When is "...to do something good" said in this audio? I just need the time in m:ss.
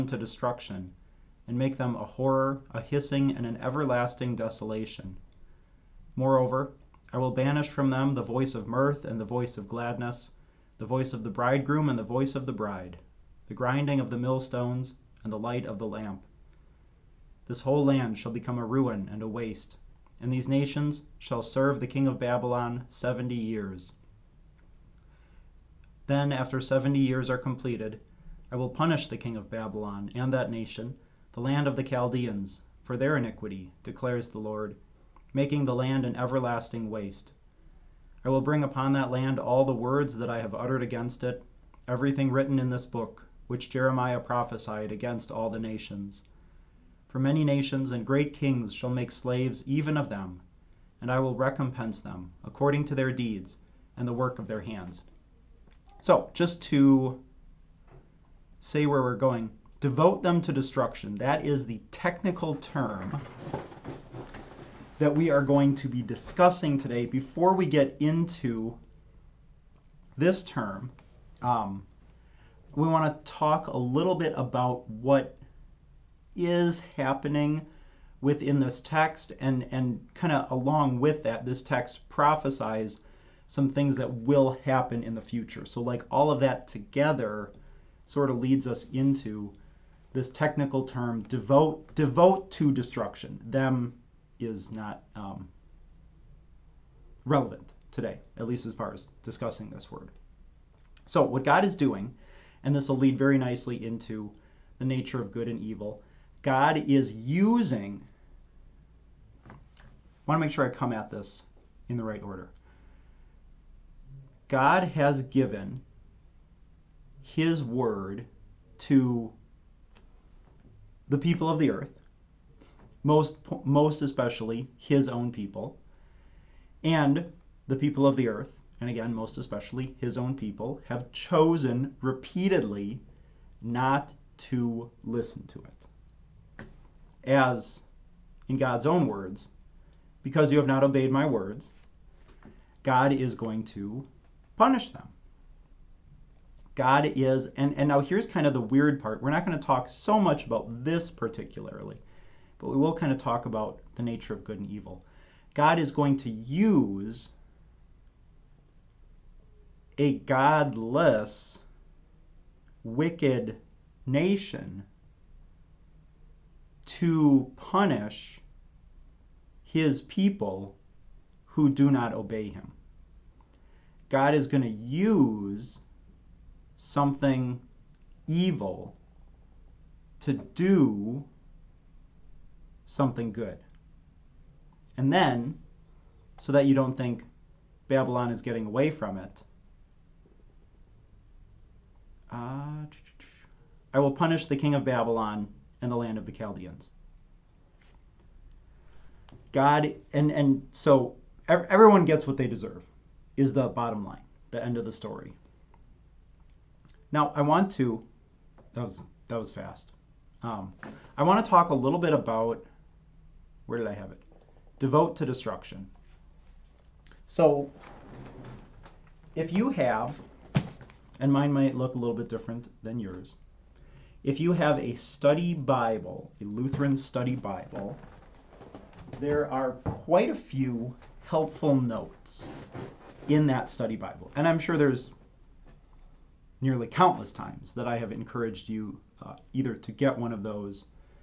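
3:00.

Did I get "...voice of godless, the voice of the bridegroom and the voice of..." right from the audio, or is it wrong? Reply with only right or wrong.
wrong.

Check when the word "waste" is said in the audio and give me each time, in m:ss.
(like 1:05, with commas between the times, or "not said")
0:19, 0:36.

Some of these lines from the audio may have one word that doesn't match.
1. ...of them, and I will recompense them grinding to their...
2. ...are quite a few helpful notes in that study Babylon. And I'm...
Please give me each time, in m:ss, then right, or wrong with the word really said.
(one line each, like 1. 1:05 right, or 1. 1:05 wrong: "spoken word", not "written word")
1. 0:49 wrong: "according", not "grinding"
2. 3:49 wrong: "Bible", not "Babylon".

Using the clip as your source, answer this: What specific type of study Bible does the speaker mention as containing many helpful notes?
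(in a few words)
Lutheran study Bible.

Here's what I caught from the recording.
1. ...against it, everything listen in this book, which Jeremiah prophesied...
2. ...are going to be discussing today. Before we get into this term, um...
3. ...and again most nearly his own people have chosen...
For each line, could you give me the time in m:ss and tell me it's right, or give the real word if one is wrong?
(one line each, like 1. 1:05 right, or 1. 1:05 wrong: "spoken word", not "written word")
1. 0:40 wrong: "written", not "listen"
2. 1:05 right
3. 2:08 wrong: "especially", not "nearly".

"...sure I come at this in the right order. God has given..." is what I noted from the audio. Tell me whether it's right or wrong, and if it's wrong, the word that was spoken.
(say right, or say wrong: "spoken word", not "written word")
right.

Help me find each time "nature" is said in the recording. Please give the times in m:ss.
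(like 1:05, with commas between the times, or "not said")
1:44, 2:34.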